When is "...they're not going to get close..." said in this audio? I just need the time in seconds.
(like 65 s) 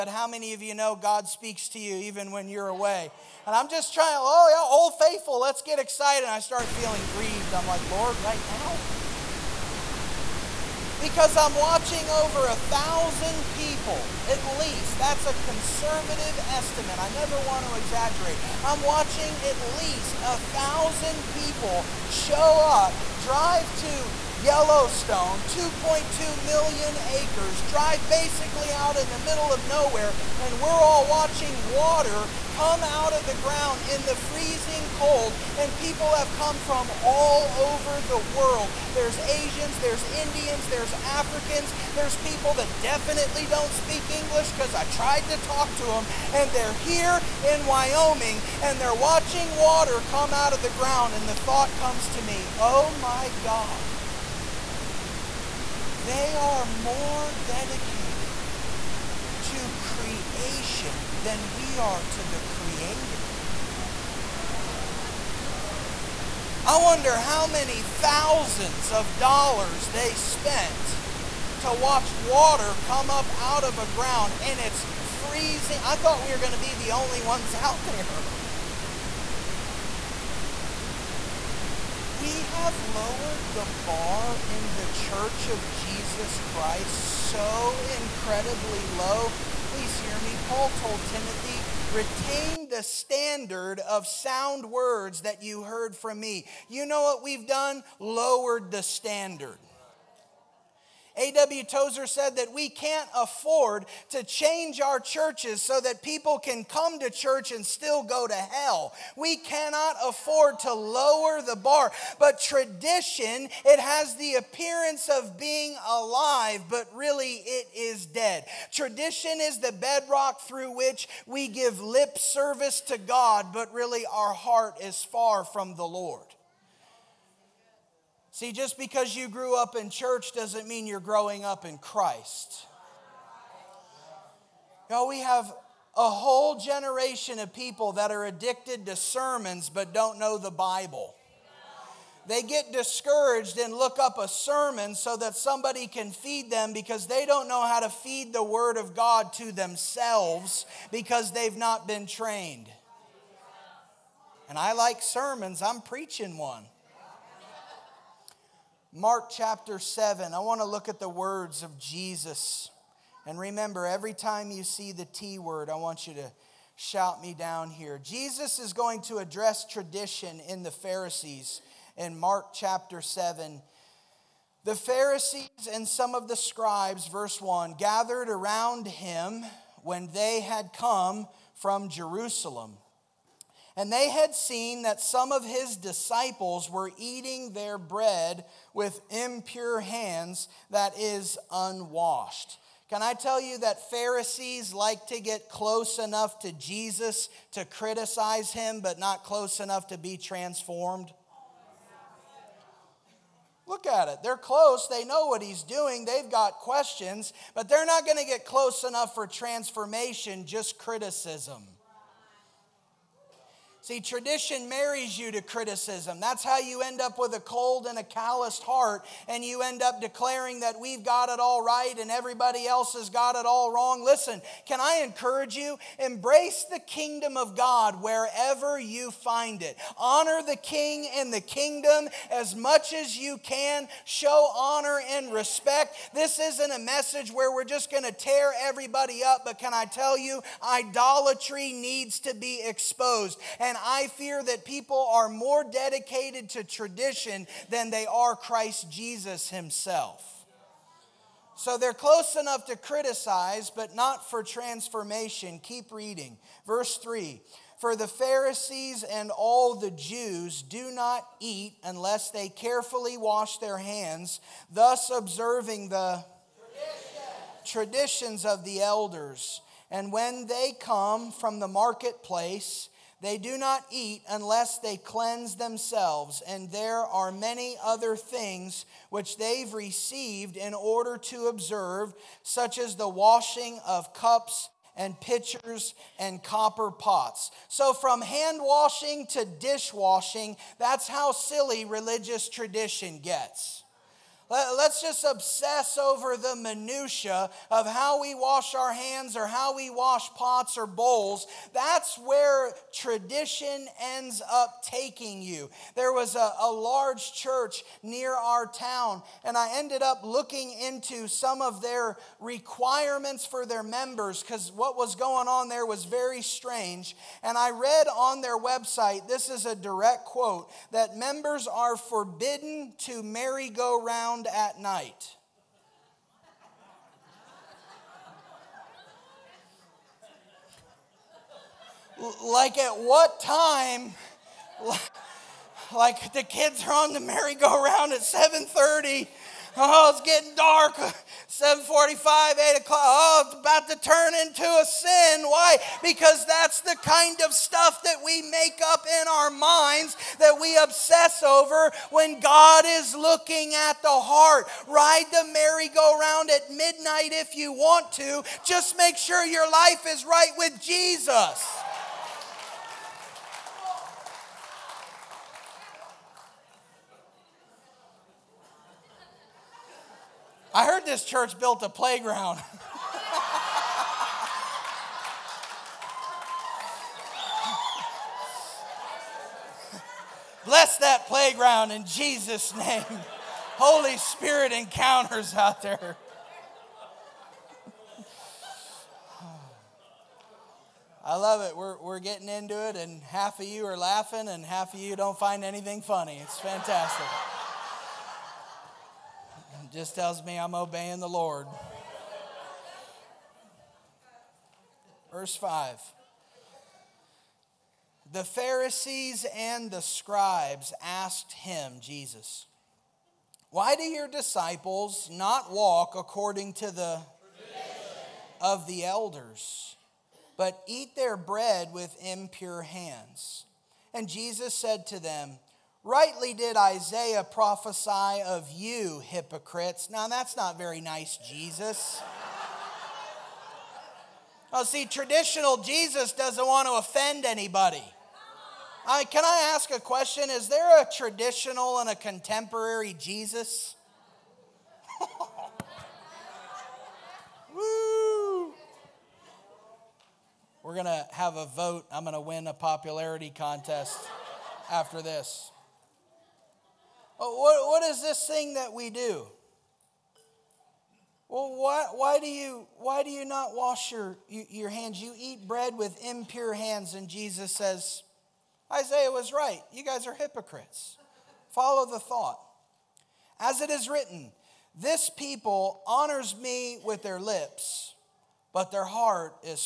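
207 s.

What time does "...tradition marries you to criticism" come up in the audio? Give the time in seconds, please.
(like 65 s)
214 s.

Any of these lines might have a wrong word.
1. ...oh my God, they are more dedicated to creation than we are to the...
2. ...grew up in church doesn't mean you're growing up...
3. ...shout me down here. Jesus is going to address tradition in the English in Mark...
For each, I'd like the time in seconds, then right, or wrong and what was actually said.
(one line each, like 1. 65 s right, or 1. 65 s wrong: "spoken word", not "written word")
1. 52 s right
2. 129 s right
3. 166 s wrong: "Pharisees", not "English".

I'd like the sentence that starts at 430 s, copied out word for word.
Now, that's not very nice, Jesus.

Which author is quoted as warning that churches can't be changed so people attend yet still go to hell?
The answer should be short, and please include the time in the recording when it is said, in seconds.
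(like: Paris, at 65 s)
A.W. Tozer, at 101 s.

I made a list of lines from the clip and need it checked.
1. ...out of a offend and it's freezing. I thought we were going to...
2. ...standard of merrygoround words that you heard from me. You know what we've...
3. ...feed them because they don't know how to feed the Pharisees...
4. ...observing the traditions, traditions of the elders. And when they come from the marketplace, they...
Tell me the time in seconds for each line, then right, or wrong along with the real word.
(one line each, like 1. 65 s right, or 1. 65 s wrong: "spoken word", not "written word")
1. 73 s wrong: "ground", not "offend"
2. 92 s wrong: "sound", not "merrygoround"
3. 146 s wrong: "Word", not "Pharisees"
4. 265 s right.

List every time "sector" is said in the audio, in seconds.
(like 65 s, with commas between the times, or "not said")
not said.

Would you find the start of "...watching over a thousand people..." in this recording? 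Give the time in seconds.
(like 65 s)
11 s.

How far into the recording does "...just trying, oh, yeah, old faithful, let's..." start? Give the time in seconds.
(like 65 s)
3 s.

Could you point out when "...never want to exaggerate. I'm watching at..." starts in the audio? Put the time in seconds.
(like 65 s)
17 s.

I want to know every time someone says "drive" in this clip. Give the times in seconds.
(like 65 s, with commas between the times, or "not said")
23 s, 27 s.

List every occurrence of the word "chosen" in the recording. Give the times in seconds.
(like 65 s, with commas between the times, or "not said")
not said.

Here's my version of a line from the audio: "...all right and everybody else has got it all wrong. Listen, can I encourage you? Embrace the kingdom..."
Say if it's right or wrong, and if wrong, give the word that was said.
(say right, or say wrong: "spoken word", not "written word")
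right.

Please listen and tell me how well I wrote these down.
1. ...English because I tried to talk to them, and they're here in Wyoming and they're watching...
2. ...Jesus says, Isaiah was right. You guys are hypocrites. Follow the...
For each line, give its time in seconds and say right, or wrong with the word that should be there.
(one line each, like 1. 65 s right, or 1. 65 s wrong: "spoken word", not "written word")
1. 44 s right
2. 467 s right.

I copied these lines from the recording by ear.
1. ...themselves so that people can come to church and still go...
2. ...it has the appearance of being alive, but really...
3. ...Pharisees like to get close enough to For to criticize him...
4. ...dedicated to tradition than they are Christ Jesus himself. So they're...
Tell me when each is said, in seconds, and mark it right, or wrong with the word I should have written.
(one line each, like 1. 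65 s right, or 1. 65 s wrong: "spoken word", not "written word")
1. 104 s wrong: "churches", not "themselves"
2. 113 s right
3. 193 s wrong: "Jesus", not "For"
4. 245 s right.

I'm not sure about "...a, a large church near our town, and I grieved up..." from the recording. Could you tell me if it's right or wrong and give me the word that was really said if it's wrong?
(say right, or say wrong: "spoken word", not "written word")
wrong: "ended", not "grieved".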